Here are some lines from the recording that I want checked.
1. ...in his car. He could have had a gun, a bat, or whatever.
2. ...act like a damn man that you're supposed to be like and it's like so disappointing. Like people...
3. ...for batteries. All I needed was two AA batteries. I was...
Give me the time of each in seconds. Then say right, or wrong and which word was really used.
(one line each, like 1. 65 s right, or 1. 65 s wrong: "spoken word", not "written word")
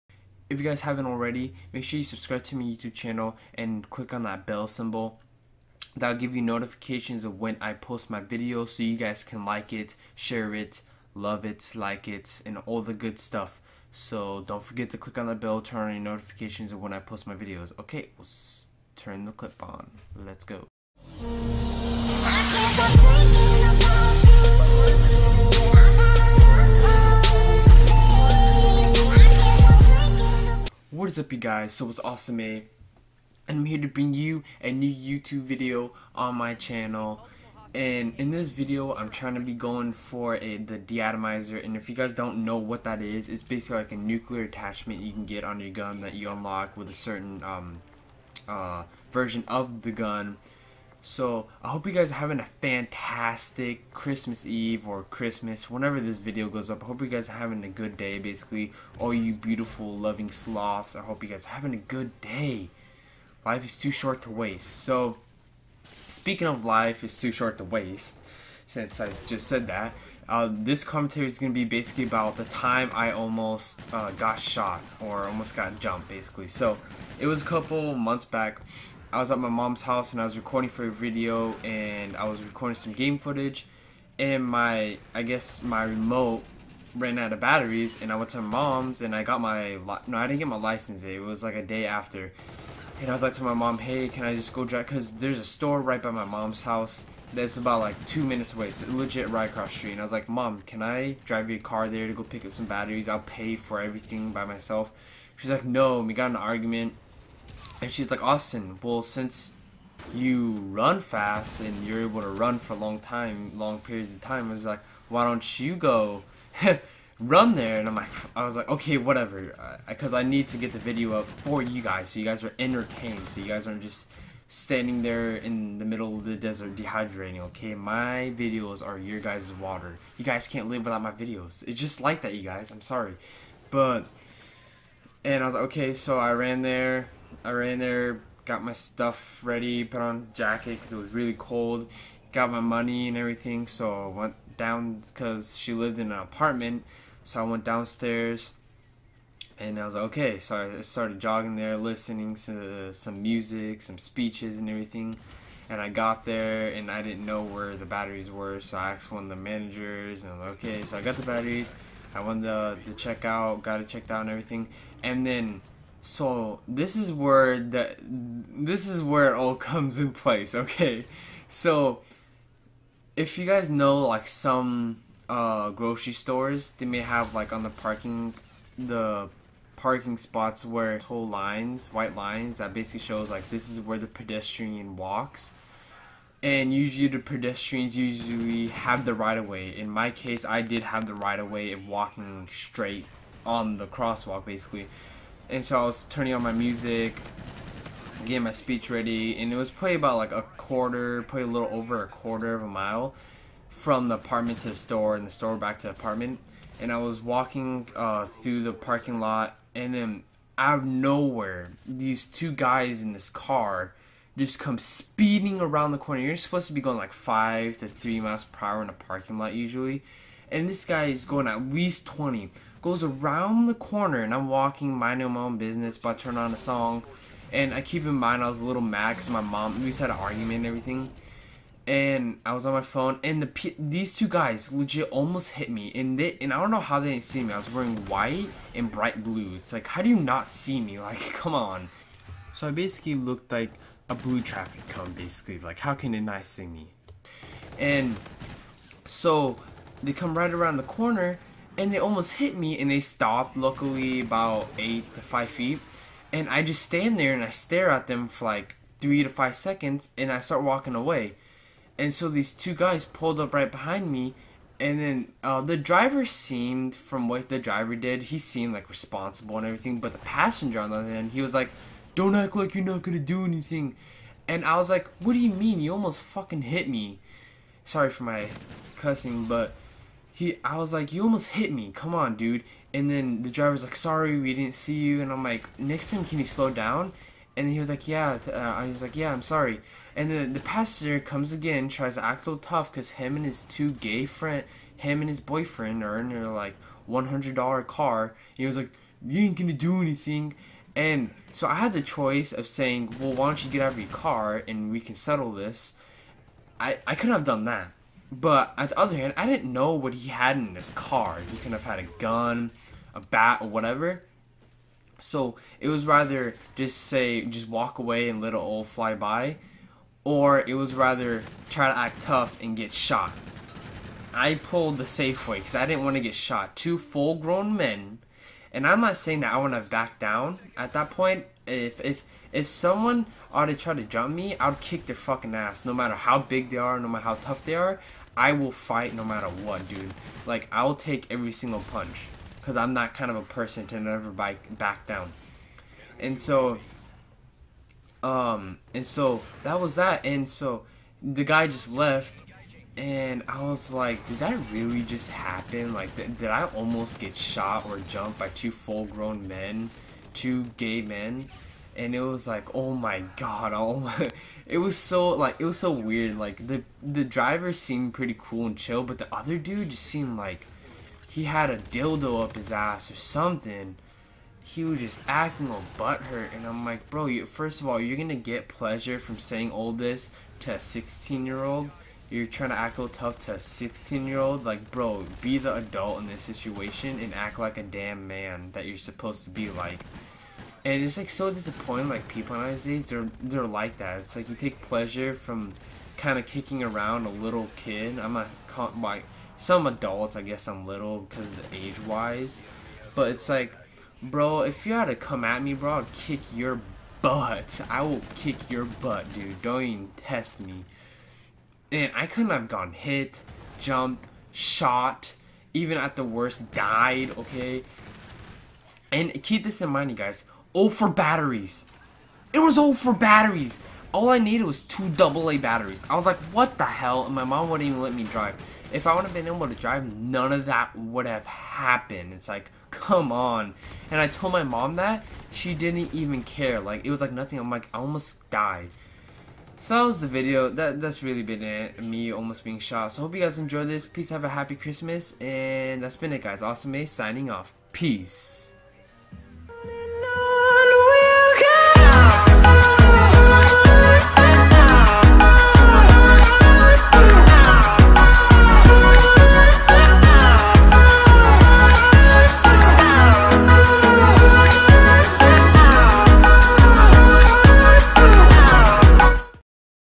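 1. 310 s right
2. 387 s right
3. 422 s right.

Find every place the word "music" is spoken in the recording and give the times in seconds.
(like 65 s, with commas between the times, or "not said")
153 s, 196 s.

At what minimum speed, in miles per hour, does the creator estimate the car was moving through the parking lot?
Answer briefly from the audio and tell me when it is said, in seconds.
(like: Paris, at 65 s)
20, at 222 s.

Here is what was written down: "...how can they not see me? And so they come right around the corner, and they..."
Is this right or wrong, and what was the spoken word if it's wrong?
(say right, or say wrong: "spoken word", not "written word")
right.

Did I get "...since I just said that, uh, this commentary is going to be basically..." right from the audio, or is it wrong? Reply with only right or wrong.
right.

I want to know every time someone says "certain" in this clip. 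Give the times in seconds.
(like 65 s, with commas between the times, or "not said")
46 s.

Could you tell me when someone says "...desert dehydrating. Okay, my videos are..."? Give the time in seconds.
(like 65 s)
126 s.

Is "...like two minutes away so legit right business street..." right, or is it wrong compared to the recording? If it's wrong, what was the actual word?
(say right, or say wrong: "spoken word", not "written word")
wrong: "across", not "business".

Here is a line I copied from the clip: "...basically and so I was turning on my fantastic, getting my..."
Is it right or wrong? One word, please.
wrong.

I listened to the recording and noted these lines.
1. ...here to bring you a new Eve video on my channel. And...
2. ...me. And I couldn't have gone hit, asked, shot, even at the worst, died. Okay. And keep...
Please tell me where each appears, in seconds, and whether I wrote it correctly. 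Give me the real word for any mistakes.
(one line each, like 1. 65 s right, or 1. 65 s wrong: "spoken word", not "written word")
1. 33 s wrong: "YouTube", not "Eve"
2. 410 s wrong: "jumped", not "asked".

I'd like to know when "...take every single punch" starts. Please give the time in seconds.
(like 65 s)
340 s.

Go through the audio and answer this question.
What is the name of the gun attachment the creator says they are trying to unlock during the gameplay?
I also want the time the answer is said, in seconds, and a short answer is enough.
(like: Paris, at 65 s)
Deatomizer, at 40 s.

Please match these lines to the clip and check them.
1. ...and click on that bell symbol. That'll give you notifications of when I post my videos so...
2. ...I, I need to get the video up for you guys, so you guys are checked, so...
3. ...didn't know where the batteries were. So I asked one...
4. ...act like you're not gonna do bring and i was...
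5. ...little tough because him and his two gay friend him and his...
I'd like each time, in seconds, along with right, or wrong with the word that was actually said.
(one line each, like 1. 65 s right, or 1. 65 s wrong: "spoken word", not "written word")
1. 3 s right
2. 120 s wrong: "entertained", not "checked"
3. 157 s right
4. 272 s wrong: "anything", not "bring"
5. 292 s right.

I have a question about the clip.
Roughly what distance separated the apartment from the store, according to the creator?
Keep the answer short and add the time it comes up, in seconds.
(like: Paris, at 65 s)
A quarter of a mile, at 202 s.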